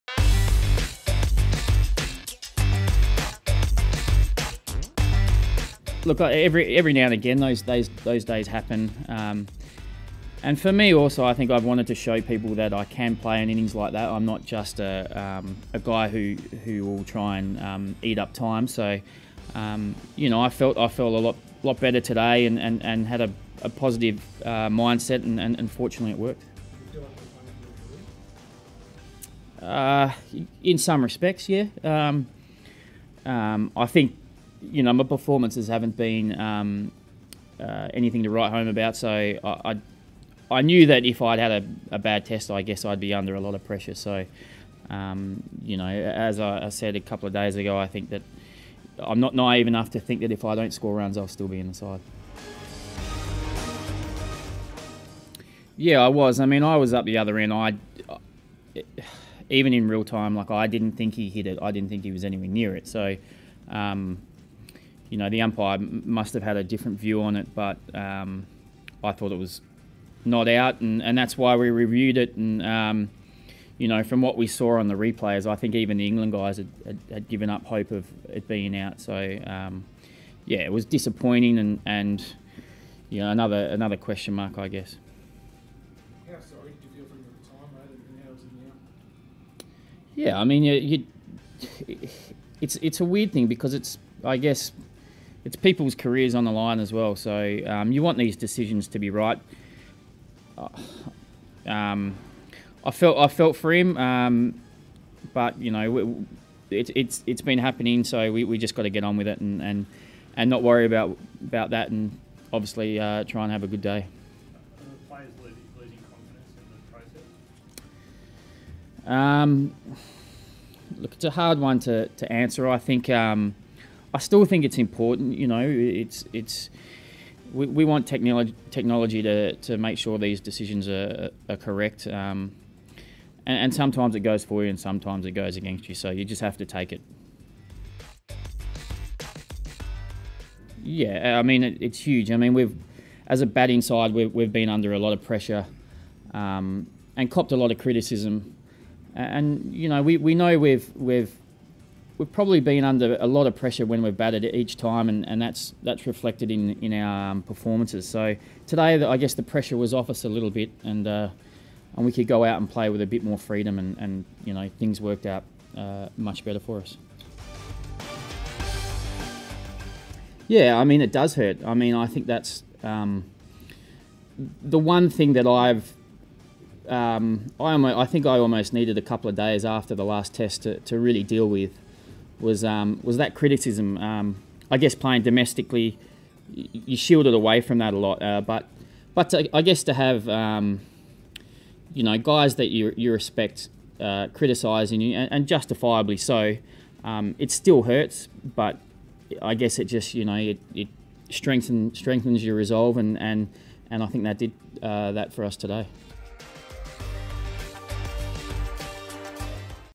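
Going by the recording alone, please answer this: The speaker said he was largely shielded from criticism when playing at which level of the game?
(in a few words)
Domestically.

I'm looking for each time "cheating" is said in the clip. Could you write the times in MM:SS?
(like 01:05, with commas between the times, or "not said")
not said.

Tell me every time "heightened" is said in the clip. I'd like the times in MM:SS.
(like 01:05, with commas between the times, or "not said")
not said.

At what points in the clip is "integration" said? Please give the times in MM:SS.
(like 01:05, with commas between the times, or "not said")
not said.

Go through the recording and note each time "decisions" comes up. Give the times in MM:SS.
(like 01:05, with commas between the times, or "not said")
01:38, 02:10.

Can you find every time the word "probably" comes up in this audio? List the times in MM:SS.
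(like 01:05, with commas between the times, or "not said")
02:32.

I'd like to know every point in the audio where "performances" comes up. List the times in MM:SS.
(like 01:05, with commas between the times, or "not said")
00:35, 02:37.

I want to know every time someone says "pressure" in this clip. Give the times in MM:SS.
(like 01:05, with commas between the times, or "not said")
00:43, 02:25, 02:33, 02:39.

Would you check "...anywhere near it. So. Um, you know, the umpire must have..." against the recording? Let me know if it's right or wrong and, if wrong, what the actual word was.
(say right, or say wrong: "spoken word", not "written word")
right.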